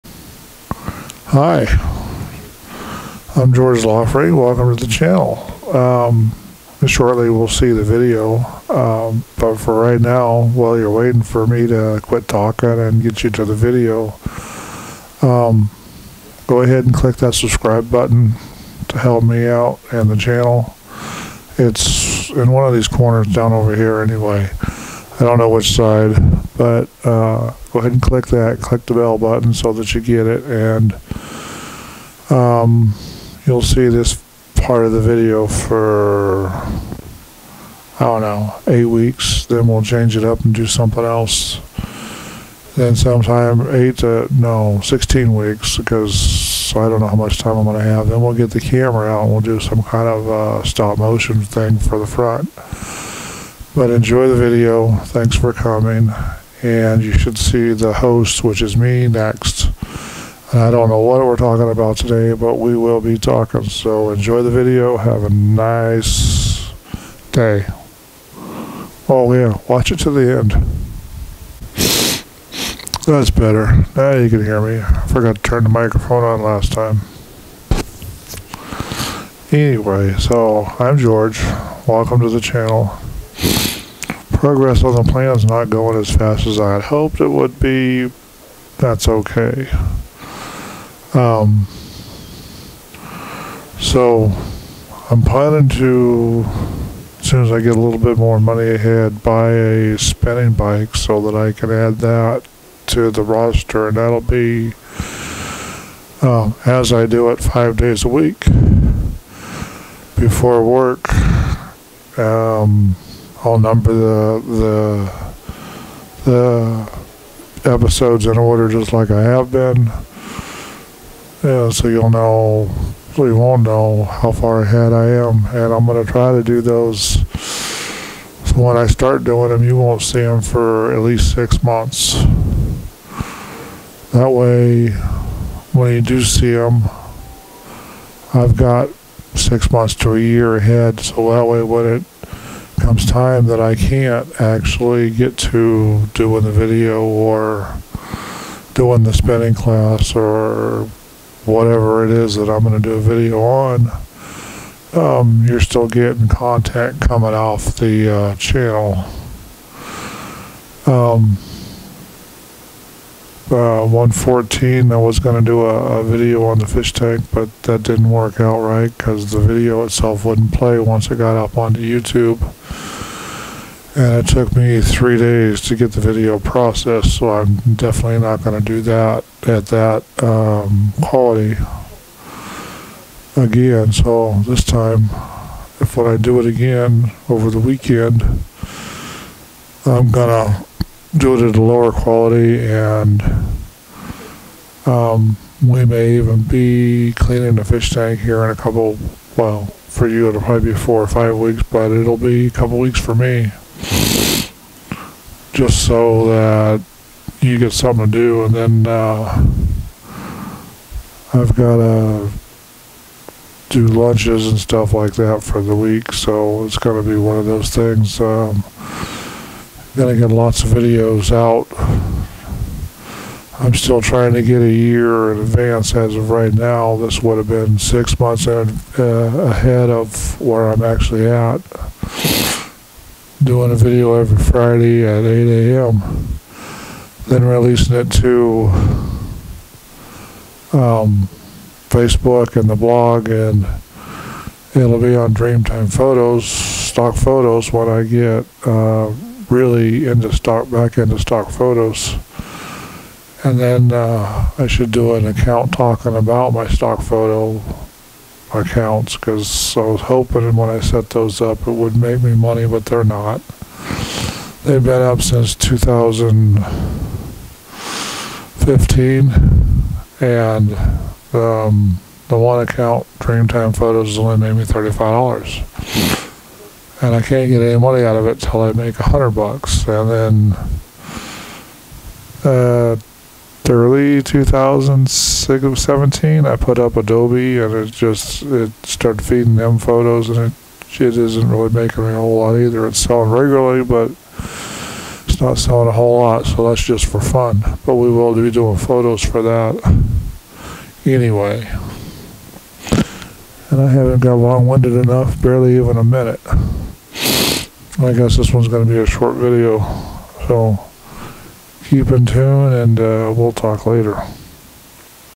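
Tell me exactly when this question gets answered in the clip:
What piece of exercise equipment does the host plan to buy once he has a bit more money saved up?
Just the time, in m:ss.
1:39.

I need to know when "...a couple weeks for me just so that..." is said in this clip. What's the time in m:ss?
3:22.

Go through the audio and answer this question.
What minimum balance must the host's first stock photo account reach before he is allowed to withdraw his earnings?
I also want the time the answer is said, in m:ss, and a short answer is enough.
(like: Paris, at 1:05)
$100, at 4:38.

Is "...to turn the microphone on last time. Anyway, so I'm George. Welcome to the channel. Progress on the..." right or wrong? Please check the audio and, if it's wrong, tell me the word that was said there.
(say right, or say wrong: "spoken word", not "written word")
right.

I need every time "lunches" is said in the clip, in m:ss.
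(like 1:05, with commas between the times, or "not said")
3:33.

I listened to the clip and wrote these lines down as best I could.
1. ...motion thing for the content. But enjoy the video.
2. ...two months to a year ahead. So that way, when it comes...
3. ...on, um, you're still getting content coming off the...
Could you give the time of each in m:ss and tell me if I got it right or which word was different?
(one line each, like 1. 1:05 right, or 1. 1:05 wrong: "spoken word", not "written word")
1. 0:50 wrong: "front", not "content"
2. 2:19 wrong: "six", not "two"
3. 2:33 right.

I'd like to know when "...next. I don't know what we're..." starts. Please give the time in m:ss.
0:59.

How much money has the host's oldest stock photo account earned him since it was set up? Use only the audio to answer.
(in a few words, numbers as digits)
$35.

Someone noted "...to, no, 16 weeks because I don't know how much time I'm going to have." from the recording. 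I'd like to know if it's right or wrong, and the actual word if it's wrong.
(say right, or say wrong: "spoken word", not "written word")
right.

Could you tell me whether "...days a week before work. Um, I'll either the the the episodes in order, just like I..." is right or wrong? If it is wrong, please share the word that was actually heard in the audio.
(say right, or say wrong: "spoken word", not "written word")
wrong: "number", not "either".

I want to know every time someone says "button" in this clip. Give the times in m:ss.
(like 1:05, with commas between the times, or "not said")
0:17, 0:29.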